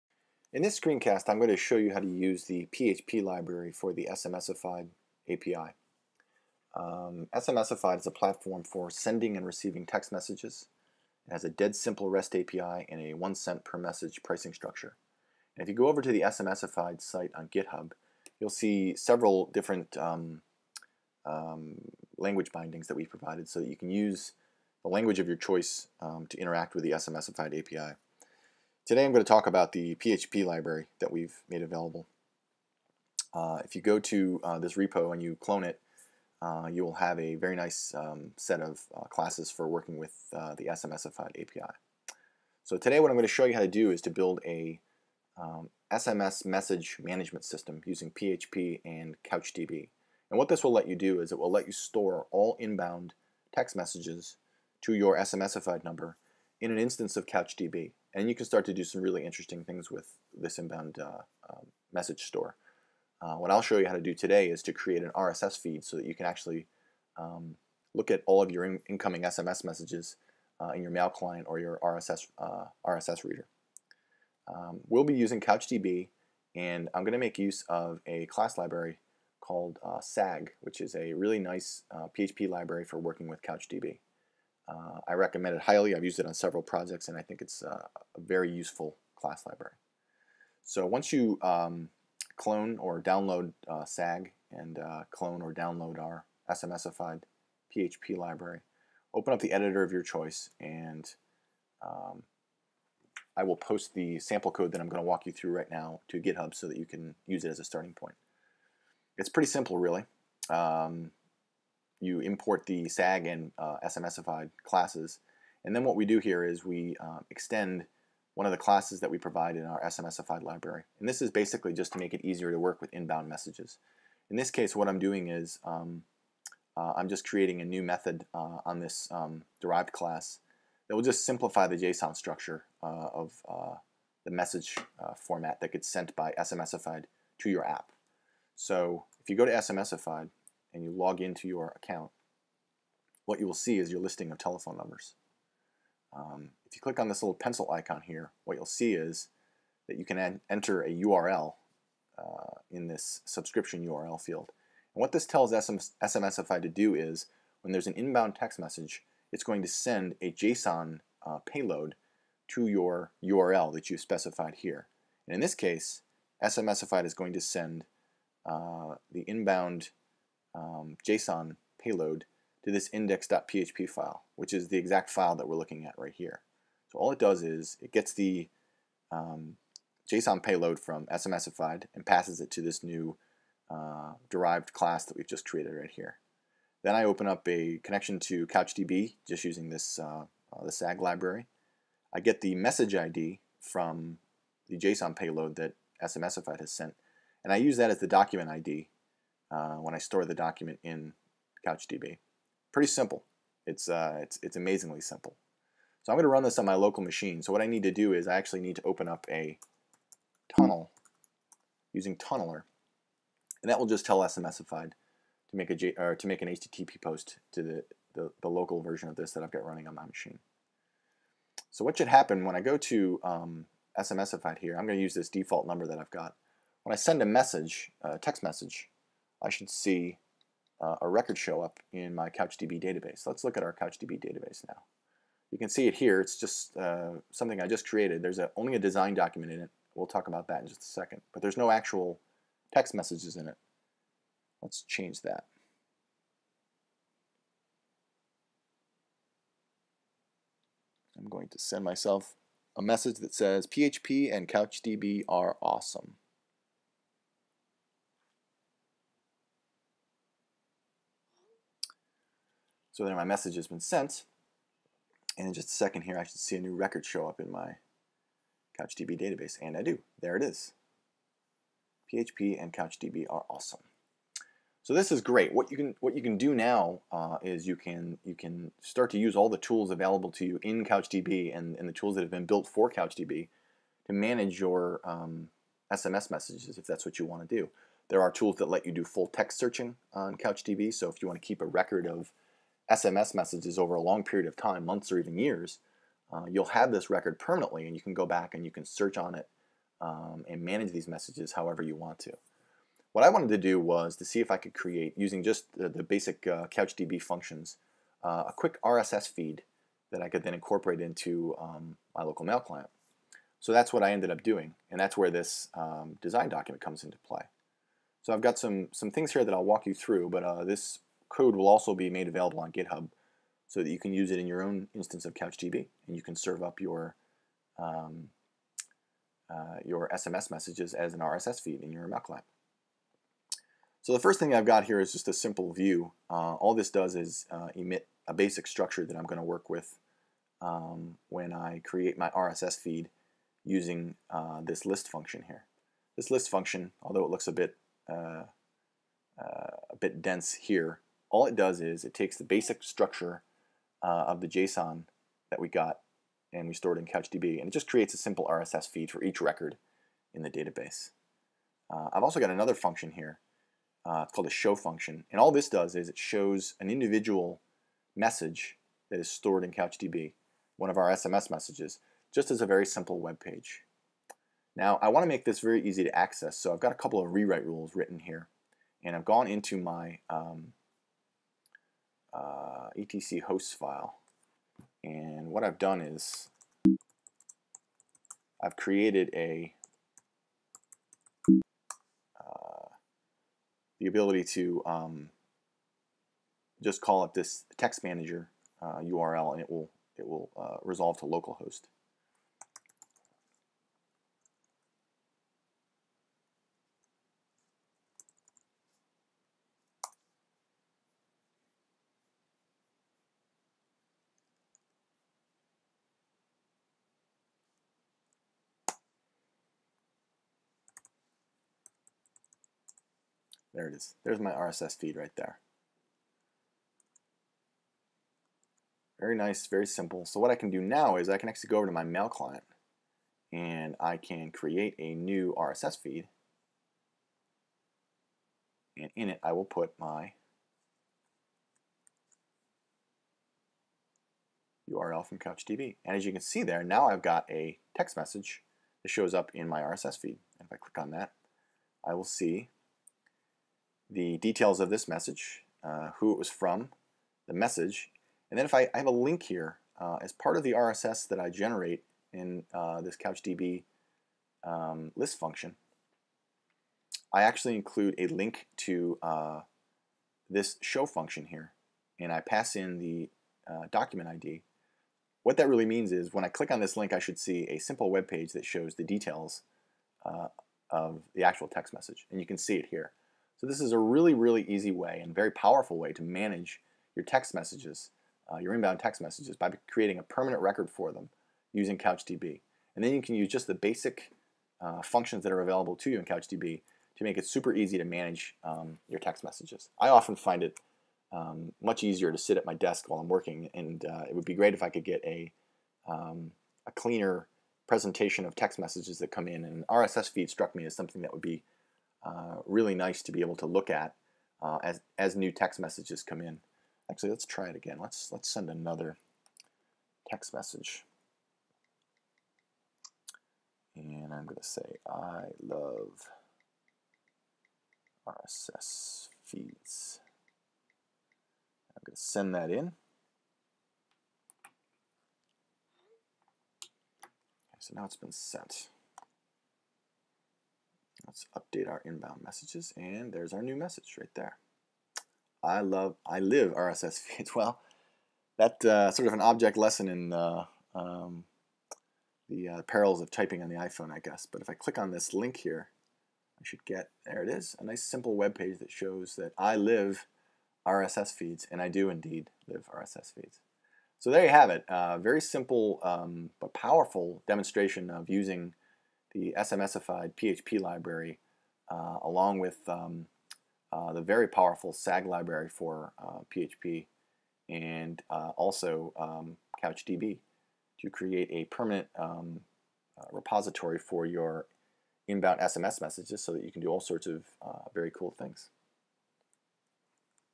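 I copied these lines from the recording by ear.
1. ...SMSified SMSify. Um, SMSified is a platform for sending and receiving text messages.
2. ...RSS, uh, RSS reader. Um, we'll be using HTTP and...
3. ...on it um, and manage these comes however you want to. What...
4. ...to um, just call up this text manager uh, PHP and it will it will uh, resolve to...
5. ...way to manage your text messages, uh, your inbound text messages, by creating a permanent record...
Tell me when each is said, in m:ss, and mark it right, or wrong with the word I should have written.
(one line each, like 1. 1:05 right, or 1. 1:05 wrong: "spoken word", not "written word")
1. 0:04 wrong: "API", not "SMSify"
2. 1:11 wrong: "CouchDB", not "HTTP"
3. 4:59 wrong: "messages", not "comes"
4. 6:34 wrong: "URL", not "PHP"
5. 8:05 right.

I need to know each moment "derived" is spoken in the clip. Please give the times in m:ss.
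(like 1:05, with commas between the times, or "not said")
2:09, 3:04.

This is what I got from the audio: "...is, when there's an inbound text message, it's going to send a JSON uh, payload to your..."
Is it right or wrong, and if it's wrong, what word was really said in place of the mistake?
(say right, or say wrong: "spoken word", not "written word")
right.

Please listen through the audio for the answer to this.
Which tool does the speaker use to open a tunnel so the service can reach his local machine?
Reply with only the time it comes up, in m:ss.
3:32.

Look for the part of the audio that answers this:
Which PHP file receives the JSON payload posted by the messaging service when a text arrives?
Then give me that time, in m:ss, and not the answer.
2:52.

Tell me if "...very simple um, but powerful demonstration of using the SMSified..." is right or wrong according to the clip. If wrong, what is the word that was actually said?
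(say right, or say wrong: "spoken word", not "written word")
right.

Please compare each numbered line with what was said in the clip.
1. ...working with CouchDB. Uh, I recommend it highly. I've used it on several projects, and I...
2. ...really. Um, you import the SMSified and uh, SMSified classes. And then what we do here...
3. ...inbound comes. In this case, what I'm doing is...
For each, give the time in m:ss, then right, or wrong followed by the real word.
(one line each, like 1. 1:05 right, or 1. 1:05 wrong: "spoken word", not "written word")
1. 1:22 right
2. 1:49 wrong: "SAG", not "SMSified"
3. 2:02 wrong: "messages", not "comes".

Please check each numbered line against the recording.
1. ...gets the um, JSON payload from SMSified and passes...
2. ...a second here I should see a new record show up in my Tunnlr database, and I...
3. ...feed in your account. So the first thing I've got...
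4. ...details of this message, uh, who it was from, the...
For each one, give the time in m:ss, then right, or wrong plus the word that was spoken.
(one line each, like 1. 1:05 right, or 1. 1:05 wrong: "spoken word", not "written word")
1. 2:57 right
2. 4:25 wrong: "CouchDB", not "Tunnlr"
3. 5:31 wrong: "client", not "account"
4. 7:34 right.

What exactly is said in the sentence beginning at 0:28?
Today I'm going to talk about the PHP library that we've made available.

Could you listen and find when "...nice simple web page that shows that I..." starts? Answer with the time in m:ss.
9:17.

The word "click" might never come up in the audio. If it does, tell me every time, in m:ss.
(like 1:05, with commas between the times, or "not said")
2:26, 7:30, 7:56, 9:14.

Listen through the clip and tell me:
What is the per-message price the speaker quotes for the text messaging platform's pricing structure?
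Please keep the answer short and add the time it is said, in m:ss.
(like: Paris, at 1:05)
one cent, at 0:13.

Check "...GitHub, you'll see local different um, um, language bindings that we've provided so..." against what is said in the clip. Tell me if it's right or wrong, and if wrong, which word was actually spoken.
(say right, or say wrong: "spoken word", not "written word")
wrong: "several", not "local".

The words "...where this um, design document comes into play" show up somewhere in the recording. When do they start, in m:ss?
5:15.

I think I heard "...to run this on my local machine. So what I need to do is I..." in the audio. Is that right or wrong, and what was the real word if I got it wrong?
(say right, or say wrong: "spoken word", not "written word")
right.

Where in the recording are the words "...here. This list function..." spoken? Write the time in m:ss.
5:45.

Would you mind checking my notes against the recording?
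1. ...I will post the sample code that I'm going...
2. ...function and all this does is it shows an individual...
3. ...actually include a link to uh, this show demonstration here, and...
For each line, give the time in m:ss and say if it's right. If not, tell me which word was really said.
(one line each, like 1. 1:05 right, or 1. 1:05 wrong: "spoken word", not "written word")
1. 1:43 right
2. 6:04 right
3. 7:47 wrong: "function", not "demonstration".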